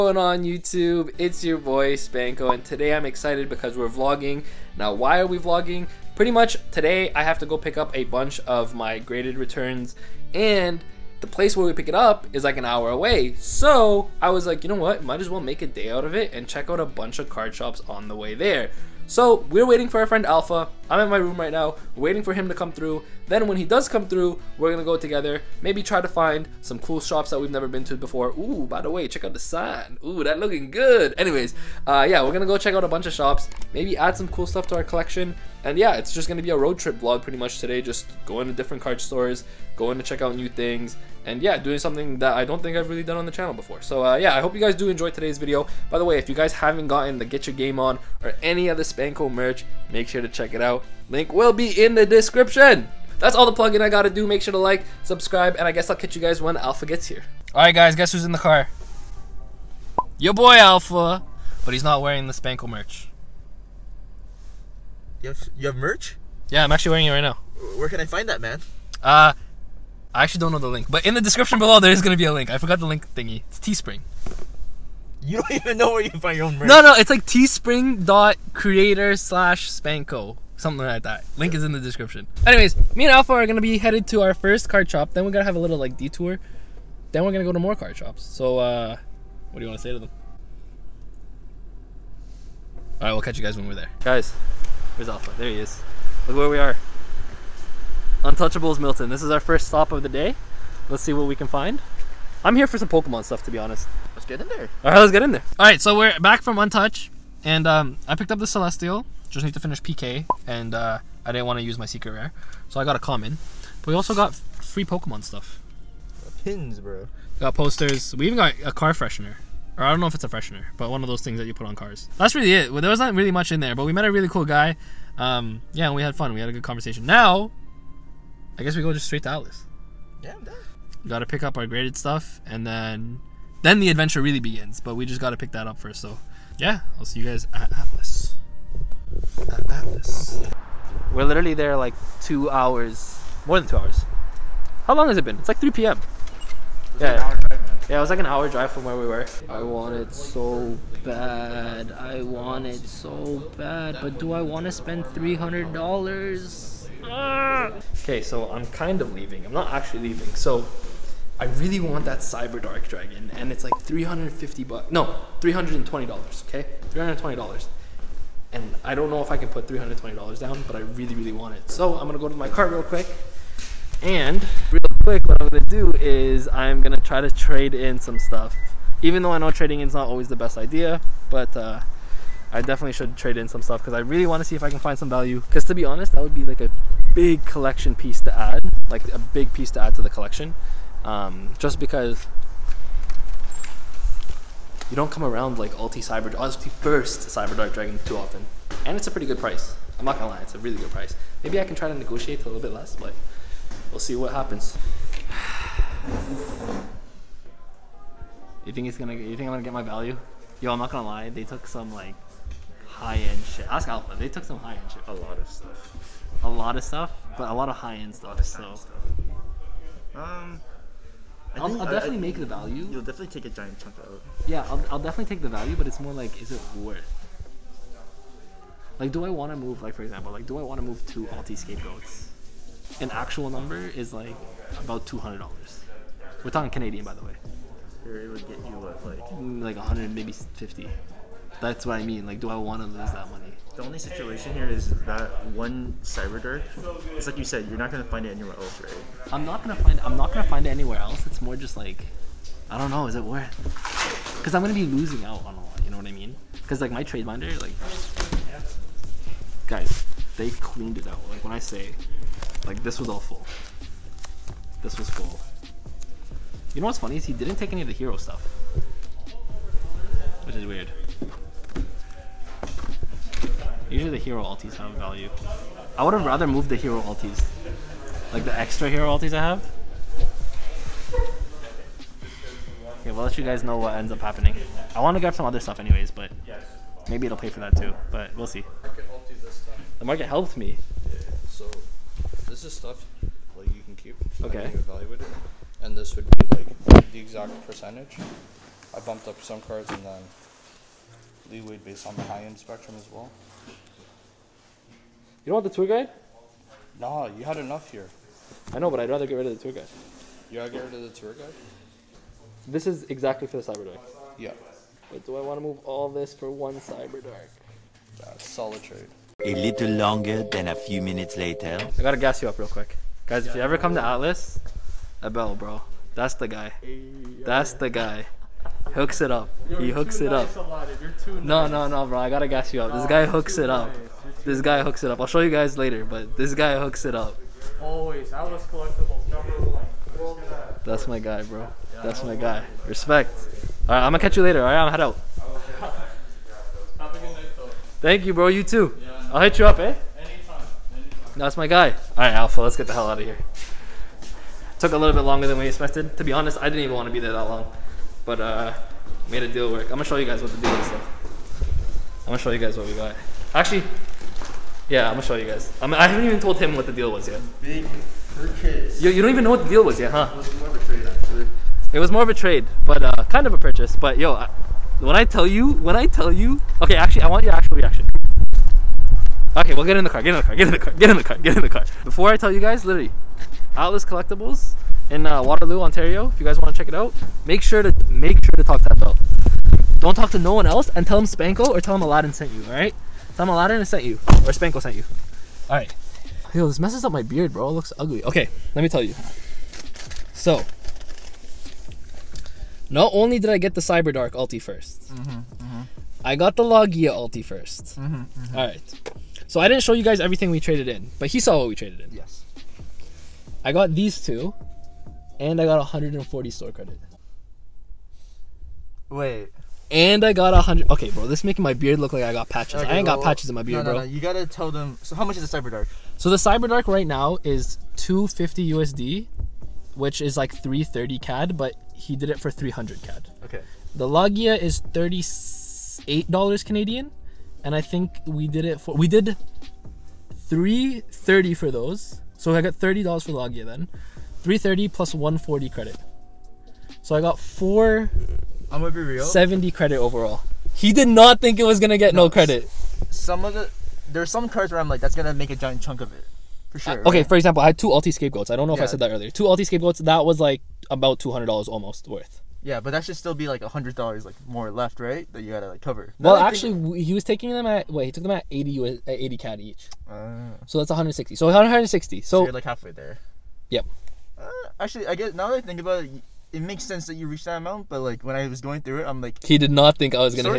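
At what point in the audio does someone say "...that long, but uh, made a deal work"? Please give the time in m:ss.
5:57.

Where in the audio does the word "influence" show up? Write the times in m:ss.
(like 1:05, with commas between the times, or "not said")
not said.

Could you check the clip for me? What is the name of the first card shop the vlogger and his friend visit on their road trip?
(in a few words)
Untouchables Milton.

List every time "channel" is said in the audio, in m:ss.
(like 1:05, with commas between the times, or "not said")
0:43.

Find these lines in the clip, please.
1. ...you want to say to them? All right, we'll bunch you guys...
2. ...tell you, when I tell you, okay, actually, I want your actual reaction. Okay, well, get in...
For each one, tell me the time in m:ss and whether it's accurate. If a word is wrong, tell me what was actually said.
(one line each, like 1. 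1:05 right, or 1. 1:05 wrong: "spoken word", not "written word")
1. 1:29 wrong: "catch", not "bunch"
2. 6:15 right.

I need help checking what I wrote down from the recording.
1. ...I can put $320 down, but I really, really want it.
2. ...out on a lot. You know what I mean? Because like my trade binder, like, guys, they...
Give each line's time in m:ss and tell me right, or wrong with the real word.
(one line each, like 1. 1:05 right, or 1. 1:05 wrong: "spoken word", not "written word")
1. 2:49 right
2. 4:15 right.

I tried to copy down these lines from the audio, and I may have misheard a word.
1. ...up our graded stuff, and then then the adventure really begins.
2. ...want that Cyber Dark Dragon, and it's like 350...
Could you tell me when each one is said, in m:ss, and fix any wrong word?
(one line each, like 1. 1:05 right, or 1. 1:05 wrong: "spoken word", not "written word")
1. 2:11 right
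2. 2:41 right.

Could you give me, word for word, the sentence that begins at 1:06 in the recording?
Yeah, I'm actually wearing it right now.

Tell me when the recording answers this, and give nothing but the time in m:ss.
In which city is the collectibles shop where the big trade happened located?
6:25.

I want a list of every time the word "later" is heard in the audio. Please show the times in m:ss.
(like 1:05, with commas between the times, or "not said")
5:21, 5:35, 5:44.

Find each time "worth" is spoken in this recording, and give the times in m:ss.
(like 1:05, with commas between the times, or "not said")
3:46, 4:13, 7:42.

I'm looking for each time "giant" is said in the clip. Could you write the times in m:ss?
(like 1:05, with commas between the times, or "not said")
3:43, 7:35.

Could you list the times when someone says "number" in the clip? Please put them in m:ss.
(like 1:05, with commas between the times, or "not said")
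3:53, 5:39.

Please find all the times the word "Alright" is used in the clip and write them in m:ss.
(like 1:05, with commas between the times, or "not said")
0:57.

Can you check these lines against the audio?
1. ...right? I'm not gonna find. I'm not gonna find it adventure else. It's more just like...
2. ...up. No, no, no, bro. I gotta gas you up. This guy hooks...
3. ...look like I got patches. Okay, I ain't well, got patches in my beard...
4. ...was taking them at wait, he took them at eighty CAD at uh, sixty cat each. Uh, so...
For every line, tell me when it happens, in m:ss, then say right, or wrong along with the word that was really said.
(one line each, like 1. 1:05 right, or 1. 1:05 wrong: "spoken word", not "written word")
1. 4:08 wrong: "anywhere", not "adventure"
2. 5:30 right
3. 7:01 right
4. 7:47 wrong: "eighty", not "sixty".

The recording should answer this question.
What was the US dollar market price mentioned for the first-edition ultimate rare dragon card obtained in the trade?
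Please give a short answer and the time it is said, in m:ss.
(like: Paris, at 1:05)
250 USD, at 7:07.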